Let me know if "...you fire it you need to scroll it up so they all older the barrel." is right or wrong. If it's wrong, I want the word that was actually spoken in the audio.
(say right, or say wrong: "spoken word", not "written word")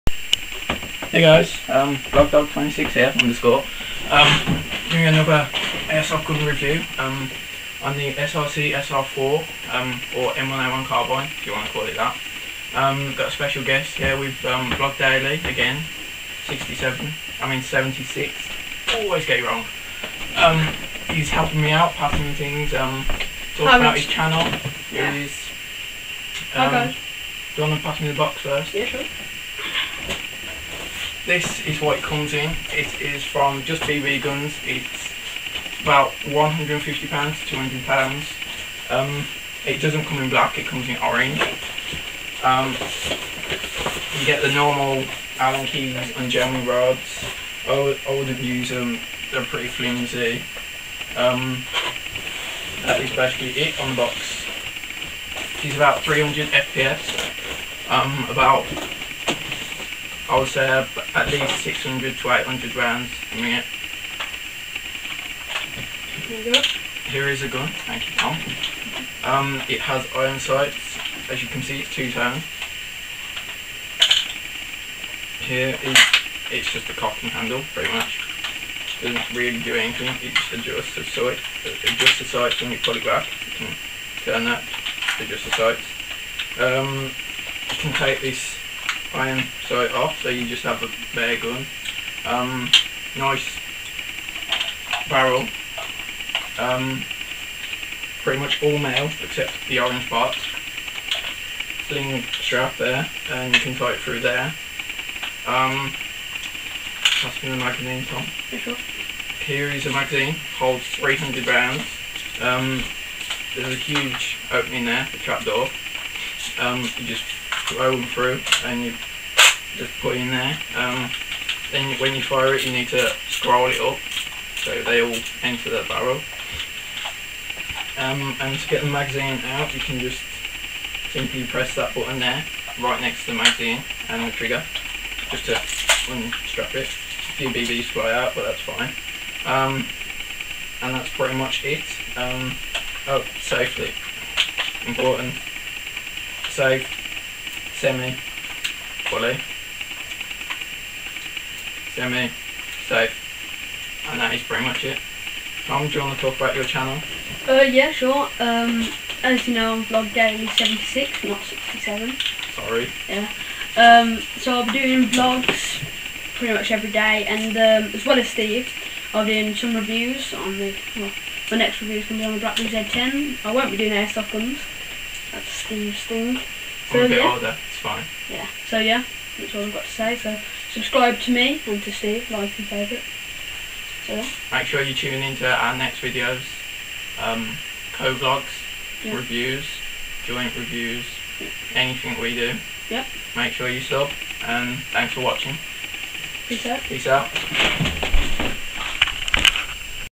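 wrong: "enter", not "older".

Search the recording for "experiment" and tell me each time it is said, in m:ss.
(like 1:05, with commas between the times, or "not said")
not said.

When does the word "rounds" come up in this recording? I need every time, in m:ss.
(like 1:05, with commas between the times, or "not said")
1:02, 1:51.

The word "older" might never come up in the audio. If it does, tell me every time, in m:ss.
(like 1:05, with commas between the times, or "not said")
2:57.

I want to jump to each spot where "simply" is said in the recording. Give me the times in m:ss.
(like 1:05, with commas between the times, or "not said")
2:11.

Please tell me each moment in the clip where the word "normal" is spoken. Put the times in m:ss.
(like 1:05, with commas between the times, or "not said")
0:44.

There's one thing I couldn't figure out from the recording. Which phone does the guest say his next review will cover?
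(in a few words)
Blackberry Z10.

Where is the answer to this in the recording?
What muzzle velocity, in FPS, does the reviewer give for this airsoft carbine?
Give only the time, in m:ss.
0:56.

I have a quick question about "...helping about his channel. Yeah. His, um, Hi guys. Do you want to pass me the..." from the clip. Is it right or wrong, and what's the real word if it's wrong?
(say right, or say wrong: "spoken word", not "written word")
wrong: "talking", not "helping".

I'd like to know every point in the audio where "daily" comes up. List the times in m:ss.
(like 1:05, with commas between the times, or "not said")
0:14, 2:40.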